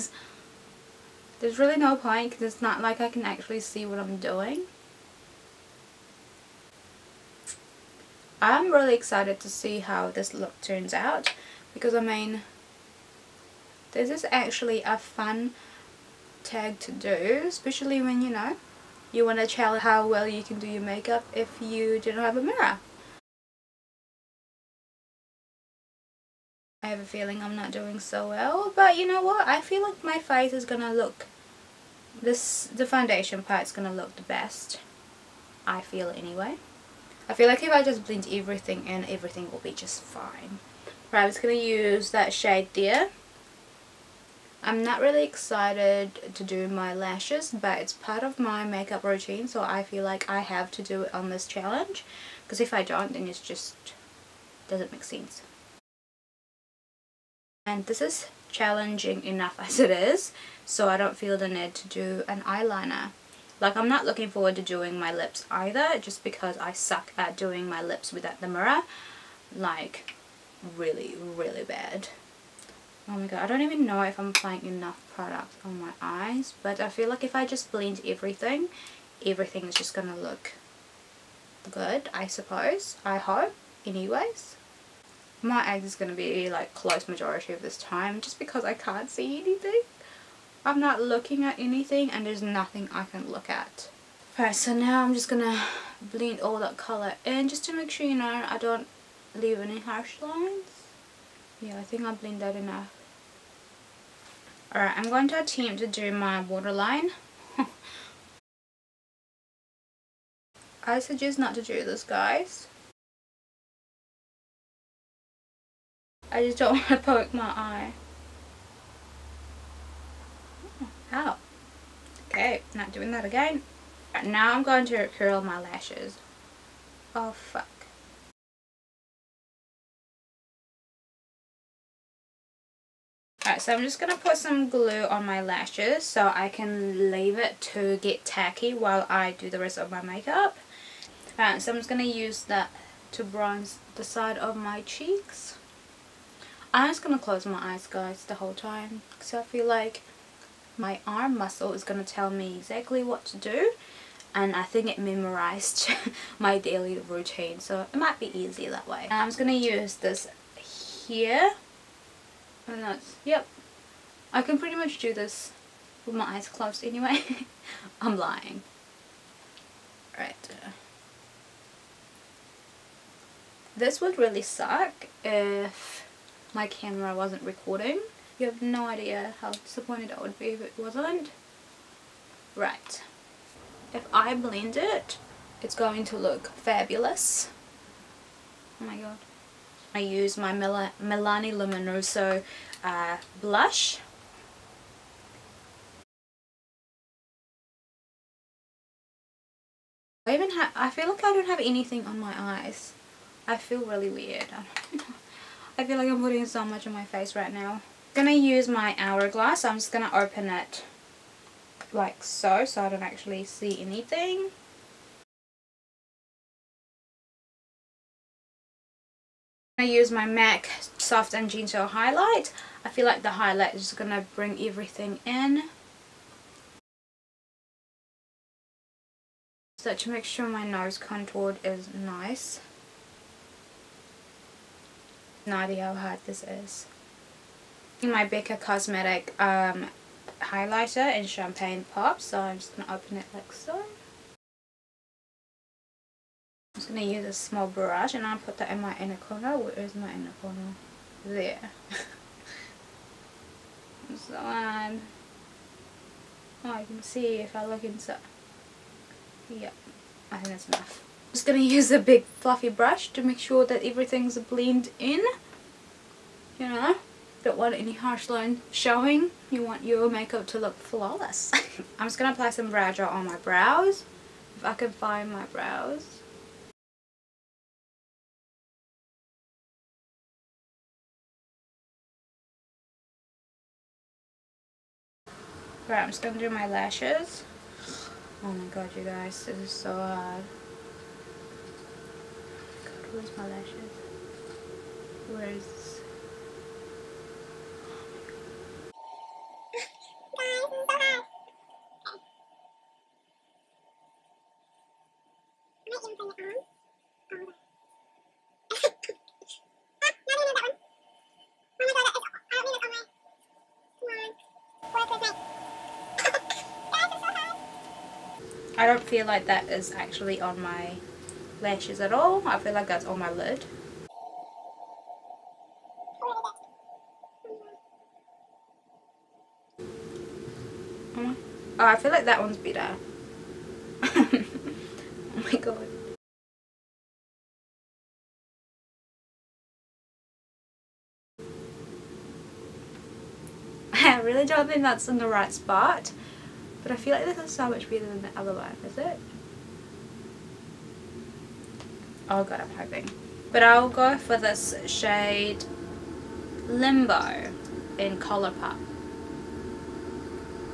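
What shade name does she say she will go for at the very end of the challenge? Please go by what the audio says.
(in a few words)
Limbo.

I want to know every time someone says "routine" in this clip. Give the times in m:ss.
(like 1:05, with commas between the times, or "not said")
0:49, 2:36.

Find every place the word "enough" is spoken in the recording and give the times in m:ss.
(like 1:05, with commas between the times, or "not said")
0:59, 1:14, 1:42, 4:20.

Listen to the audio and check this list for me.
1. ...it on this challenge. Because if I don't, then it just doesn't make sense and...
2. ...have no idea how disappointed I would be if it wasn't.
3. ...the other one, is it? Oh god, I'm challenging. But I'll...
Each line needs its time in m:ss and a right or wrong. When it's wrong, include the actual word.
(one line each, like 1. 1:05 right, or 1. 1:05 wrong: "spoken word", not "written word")
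1. 0:51 right
2. 2:58 right
3. 5:48 wrong: "hoping", not "challenging".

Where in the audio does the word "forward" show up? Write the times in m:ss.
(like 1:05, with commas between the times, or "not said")
1:04.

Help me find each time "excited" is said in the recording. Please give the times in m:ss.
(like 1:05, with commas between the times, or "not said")
0:08, 0:45.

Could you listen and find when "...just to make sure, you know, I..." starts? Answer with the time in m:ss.
1:37.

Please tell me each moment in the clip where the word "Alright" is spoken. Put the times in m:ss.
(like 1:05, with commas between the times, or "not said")
1:34, 1:44, 2:13, 2:21.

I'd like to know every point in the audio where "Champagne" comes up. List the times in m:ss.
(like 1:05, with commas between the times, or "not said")
4:01.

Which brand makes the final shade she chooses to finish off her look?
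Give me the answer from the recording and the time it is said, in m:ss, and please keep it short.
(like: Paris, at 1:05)
Color Pop, at 5:58.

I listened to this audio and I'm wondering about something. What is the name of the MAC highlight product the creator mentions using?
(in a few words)
Soft and Gentle.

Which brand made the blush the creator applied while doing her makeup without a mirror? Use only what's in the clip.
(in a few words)
Milani.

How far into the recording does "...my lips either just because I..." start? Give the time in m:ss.
1:04.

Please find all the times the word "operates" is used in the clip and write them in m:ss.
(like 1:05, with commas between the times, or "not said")
not said.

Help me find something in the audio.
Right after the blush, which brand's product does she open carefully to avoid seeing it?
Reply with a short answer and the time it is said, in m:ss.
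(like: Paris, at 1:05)
Hourglass, at 3:28.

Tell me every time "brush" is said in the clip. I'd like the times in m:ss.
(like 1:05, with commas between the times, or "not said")
4:07, 4:22.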